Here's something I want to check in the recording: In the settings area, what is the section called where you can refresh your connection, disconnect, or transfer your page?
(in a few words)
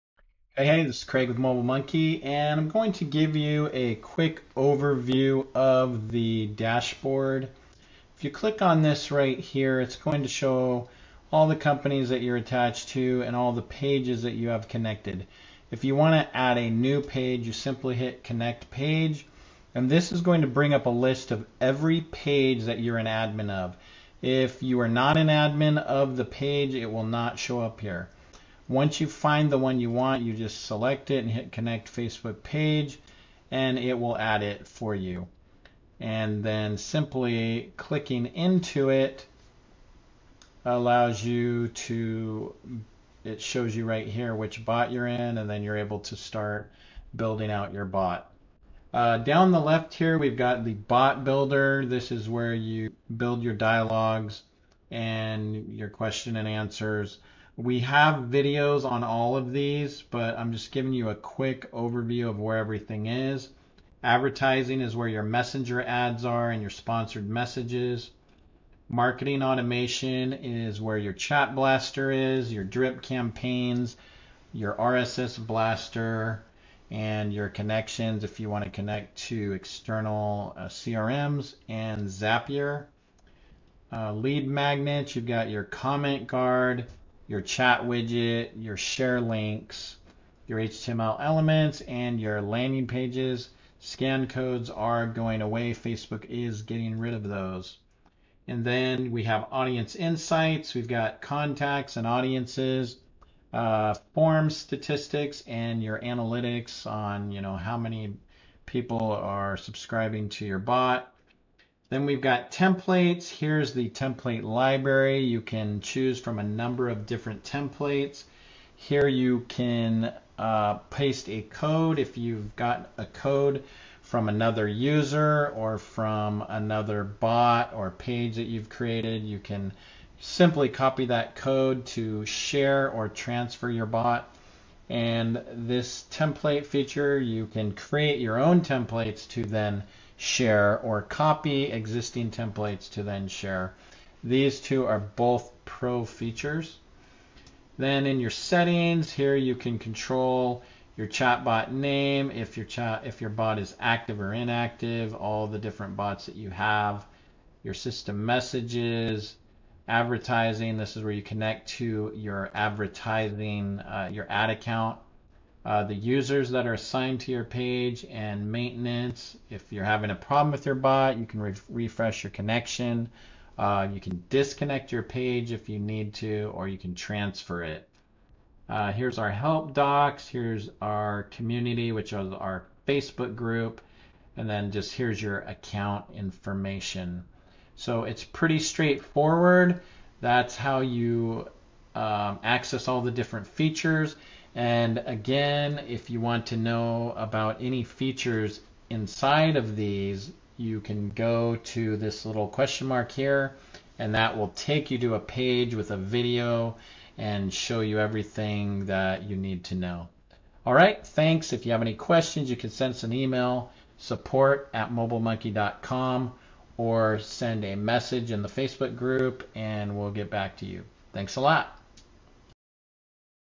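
maintenance.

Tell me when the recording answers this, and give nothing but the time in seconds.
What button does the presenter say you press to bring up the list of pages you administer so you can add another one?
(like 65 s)
18 s.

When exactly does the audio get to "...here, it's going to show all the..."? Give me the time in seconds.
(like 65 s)
9 s.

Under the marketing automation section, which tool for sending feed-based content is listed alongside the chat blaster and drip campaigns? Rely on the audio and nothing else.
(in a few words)
RSS blaster.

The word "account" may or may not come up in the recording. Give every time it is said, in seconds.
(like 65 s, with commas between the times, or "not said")
164 s, 185 s.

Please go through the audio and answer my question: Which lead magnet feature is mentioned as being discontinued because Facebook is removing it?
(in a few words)
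Scan codes.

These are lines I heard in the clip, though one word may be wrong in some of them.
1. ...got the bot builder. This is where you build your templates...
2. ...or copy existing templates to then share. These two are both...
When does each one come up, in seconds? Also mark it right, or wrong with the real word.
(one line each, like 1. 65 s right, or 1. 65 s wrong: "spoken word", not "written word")
1. 50 s wrong: "dialogues", not "templates"
2. 140 s right.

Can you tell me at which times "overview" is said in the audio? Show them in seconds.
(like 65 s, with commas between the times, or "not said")
4 s, 61 s.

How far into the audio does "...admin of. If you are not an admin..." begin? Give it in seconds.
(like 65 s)
23 s.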